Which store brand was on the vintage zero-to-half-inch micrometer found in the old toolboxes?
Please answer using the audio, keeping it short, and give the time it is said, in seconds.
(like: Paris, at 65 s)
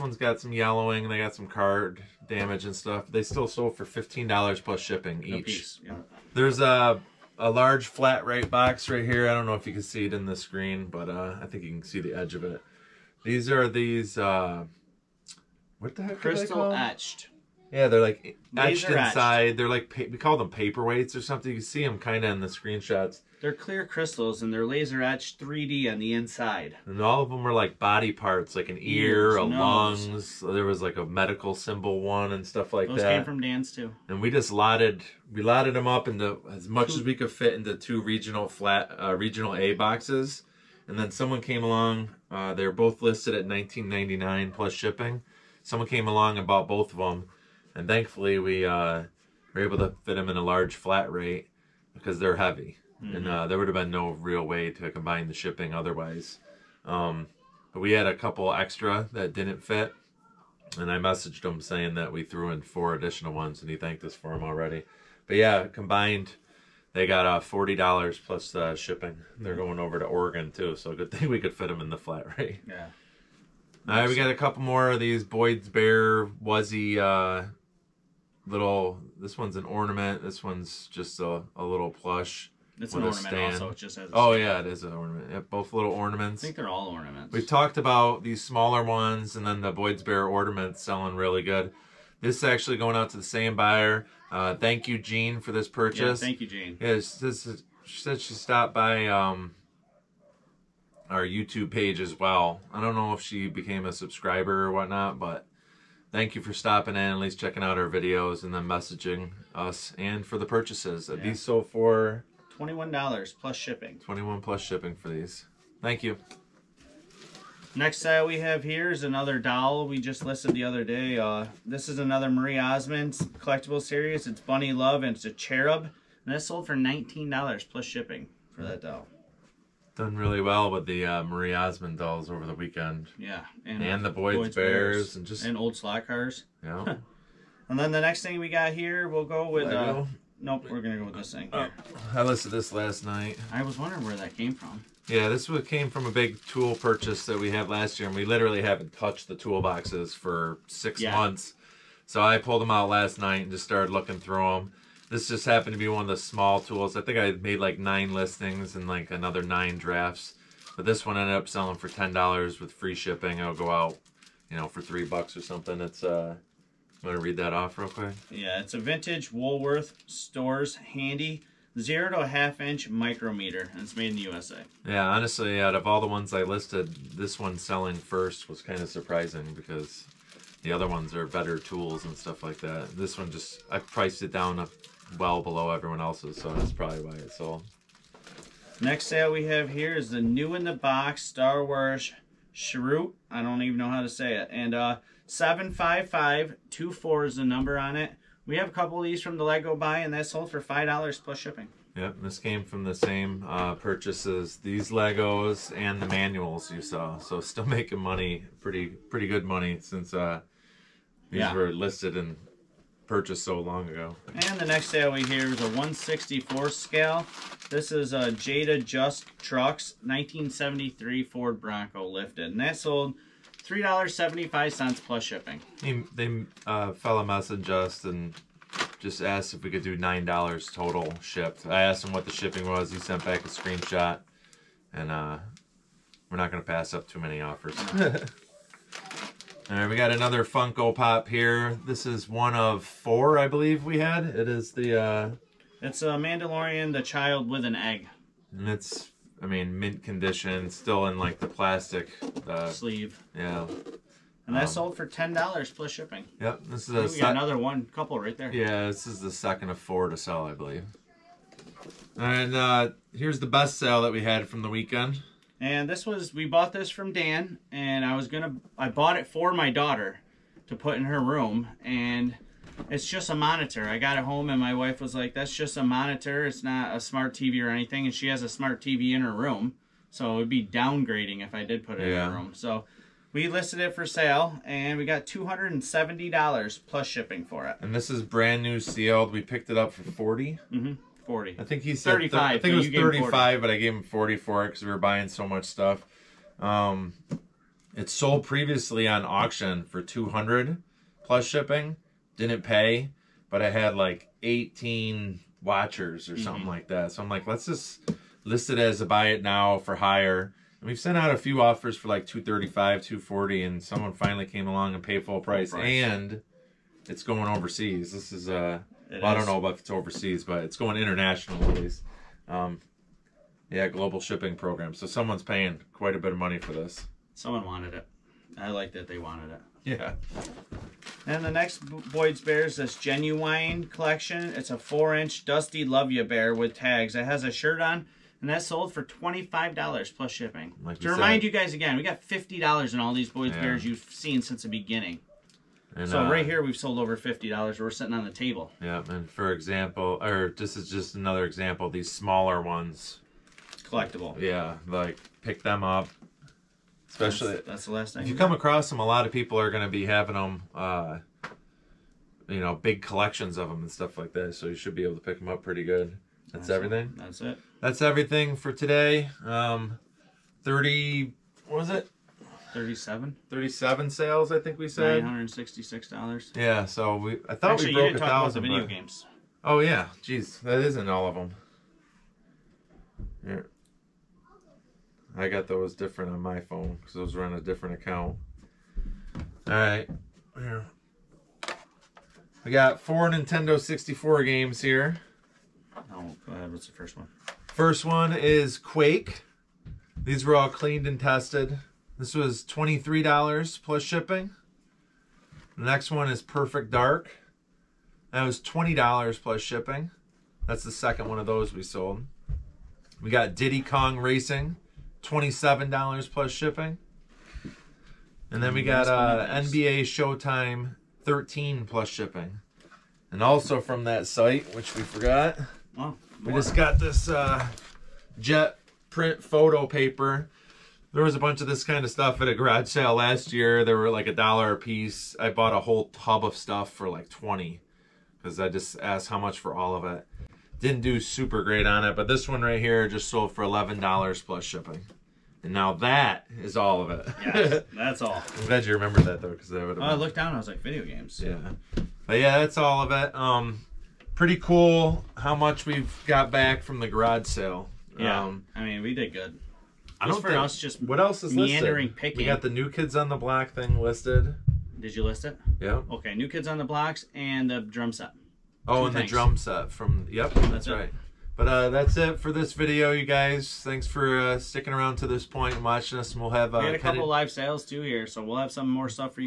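Woolworth, at 169 s.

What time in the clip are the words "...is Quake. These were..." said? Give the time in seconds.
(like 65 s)
398 s.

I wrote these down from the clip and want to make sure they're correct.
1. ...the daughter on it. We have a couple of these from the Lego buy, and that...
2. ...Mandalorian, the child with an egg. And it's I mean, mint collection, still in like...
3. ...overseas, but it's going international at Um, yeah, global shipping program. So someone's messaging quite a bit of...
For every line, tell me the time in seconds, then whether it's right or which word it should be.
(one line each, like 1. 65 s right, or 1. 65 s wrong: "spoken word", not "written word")
1. 197 s wrong: "number", not "daughter"
2. 246 s wrong: "condition", not "collection"
3. 319 s wrong: "paying", not "messaging".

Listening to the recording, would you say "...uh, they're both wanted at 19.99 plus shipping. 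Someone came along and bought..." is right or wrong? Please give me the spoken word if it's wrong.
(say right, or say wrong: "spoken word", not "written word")
wrong: "listed", not "wanted".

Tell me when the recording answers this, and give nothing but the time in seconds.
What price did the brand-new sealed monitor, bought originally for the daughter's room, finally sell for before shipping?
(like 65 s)
285 s.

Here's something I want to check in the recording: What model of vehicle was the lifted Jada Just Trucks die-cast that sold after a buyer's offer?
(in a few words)
1973 Ford Bronco.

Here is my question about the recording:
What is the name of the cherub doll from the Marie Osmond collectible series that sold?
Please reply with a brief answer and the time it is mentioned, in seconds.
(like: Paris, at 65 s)
Bunny Love, at 124 s.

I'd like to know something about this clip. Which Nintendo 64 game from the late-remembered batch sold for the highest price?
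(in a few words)
Diddy Kong Racing.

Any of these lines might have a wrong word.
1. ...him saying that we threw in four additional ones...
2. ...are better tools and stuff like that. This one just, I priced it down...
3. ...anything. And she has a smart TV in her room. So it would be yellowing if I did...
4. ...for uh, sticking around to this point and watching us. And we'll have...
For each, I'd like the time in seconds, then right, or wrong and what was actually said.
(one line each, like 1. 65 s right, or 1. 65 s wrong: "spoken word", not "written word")
1. 61 s right
2. 181 s right
3. 277 s wrong: "downgrading", not "yellowing"
4. 474 s right.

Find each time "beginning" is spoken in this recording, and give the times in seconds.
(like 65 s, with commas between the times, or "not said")
344 s.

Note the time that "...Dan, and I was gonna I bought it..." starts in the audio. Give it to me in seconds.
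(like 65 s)
267 s.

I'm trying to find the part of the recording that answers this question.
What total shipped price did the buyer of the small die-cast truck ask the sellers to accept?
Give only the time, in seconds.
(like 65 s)
229 s.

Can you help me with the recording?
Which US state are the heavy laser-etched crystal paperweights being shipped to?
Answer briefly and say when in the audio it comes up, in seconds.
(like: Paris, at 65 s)
Oregon, at 70 s.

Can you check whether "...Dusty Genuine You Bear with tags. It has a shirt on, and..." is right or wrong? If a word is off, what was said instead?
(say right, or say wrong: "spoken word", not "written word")
wrong: "Love", not "Genuine".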